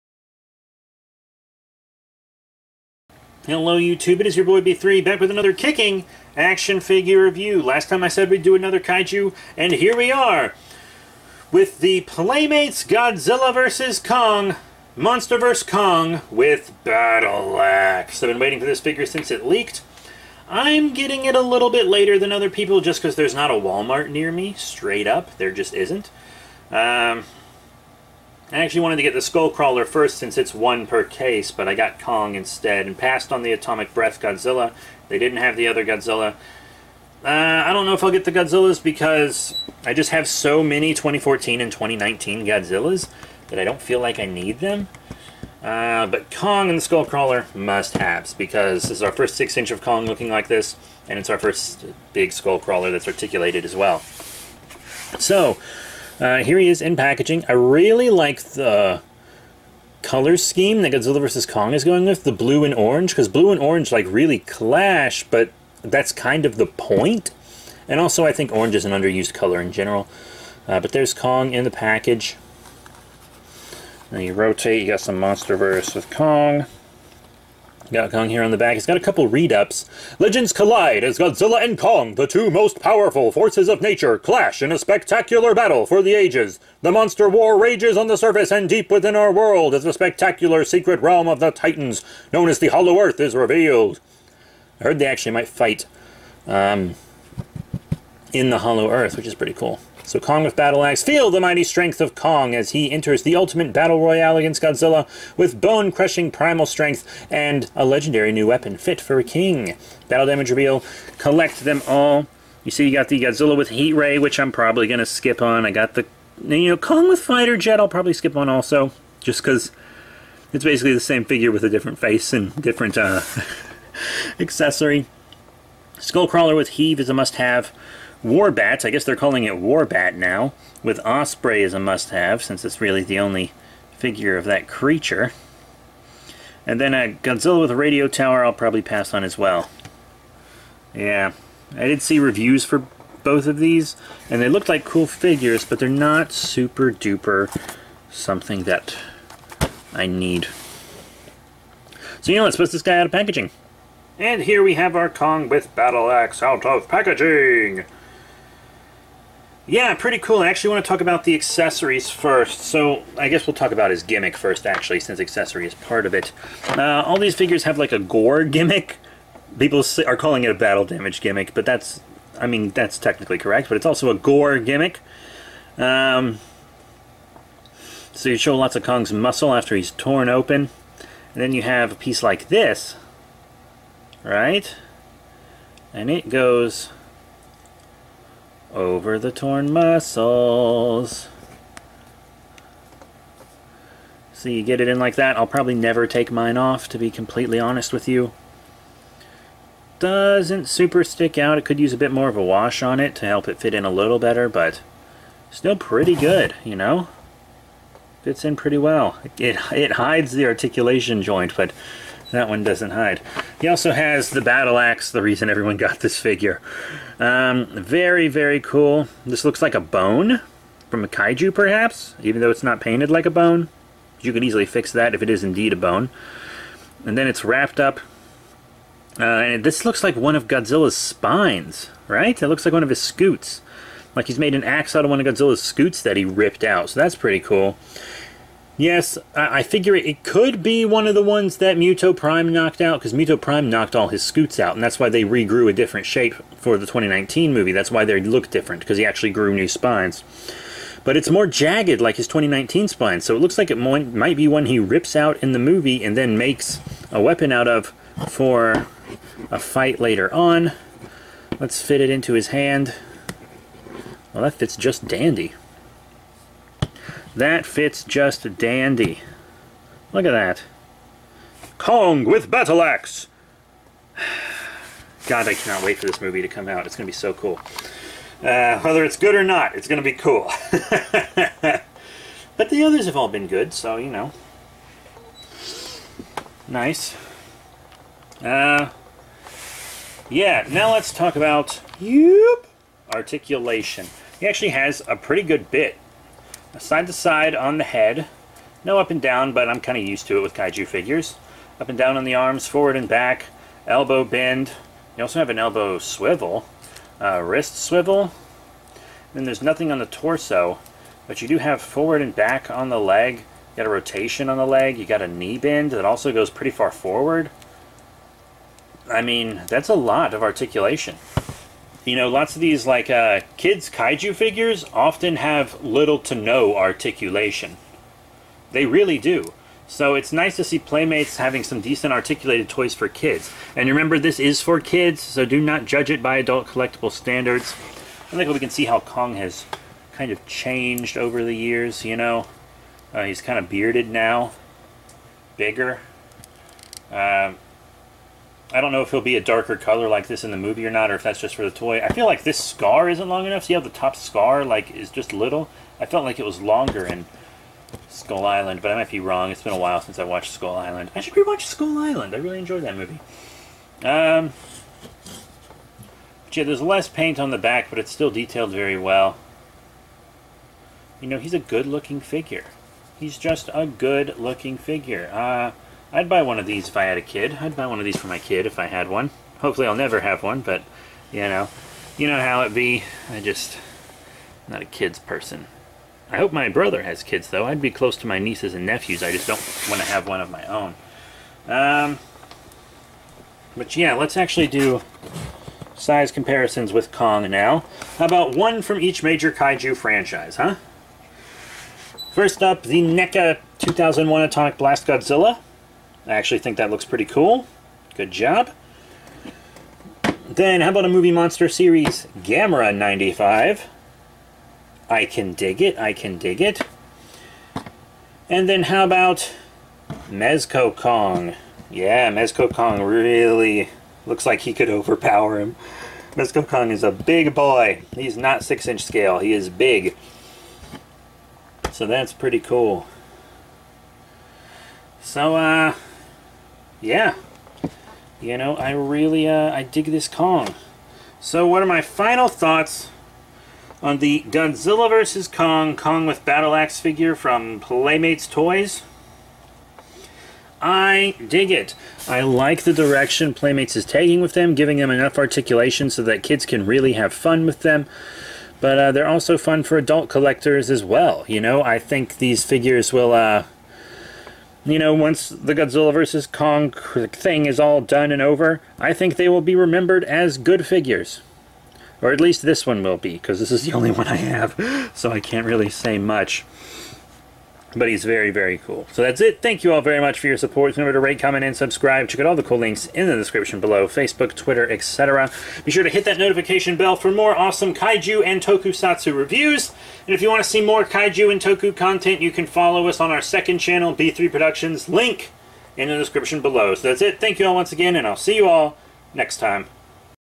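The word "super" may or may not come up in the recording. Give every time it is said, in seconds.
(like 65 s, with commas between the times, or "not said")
146 s, 200 s.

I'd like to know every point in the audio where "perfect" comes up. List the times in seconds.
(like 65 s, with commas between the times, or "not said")
not said.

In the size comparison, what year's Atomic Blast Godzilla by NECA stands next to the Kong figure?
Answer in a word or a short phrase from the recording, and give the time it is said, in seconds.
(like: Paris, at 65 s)
2001, at 403 s.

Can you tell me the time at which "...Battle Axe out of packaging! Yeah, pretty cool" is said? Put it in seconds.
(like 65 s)
155 s.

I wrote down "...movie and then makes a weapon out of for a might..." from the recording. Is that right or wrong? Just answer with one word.
wrong.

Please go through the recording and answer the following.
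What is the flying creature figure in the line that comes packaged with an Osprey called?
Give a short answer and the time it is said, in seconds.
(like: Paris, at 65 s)
Warbat, at 129 s.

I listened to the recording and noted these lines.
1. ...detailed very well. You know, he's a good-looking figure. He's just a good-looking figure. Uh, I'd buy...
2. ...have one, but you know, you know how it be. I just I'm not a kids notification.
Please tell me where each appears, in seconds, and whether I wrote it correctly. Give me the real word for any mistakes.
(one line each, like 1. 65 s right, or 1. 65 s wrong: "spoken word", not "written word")
1. 368 s right
2. 380 s wrong: "person", not "notification".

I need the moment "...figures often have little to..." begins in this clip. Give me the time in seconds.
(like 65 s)
324 s.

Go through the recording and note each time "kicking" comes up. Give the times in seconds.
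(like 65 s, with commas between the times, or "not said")
5 s.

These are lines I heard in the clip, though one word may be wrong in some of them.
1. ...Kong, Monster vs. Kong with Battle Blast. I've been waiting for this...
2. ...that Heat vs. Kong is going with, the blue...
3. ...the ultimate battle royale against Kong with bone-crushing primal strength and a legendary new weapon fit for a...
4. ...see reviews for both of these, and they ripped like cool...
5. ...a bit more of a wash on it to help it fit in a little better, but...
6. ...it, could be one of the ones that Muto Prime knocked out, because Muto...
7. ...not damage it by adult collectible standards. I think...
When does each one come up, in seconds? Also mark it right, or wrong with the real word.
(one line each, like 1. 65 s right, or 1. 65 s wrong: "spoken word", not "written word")
1. 13 s wrong: "Axe", not "Blast"
2. 60 s wrong: "Godzilla", not "Heat"
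3. 103 s wrong: "Godzilla", not "Kong"
4. 142 s wrong: "looked", not "ripped"
5. 201 s right
6. 239 s right
7. 335 s wrong: "judge", not "damage".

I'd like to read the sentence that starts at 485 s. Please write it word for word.
Be sure to hit that notification bell for more awesome kaiju and tokusatsu reviews.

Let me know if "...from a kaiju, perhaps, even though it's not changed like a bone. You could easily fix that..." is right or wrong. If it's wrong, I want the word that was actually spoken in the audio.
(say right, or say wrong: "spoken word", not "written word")
wrong: "painted", not "changed".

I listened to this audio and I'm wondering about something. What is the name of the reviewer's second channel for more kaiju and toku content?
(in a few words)
B3 Productions.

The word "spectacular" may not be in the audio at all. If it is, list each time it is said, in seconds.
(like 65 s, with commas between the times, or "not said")
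84 s, 89 s.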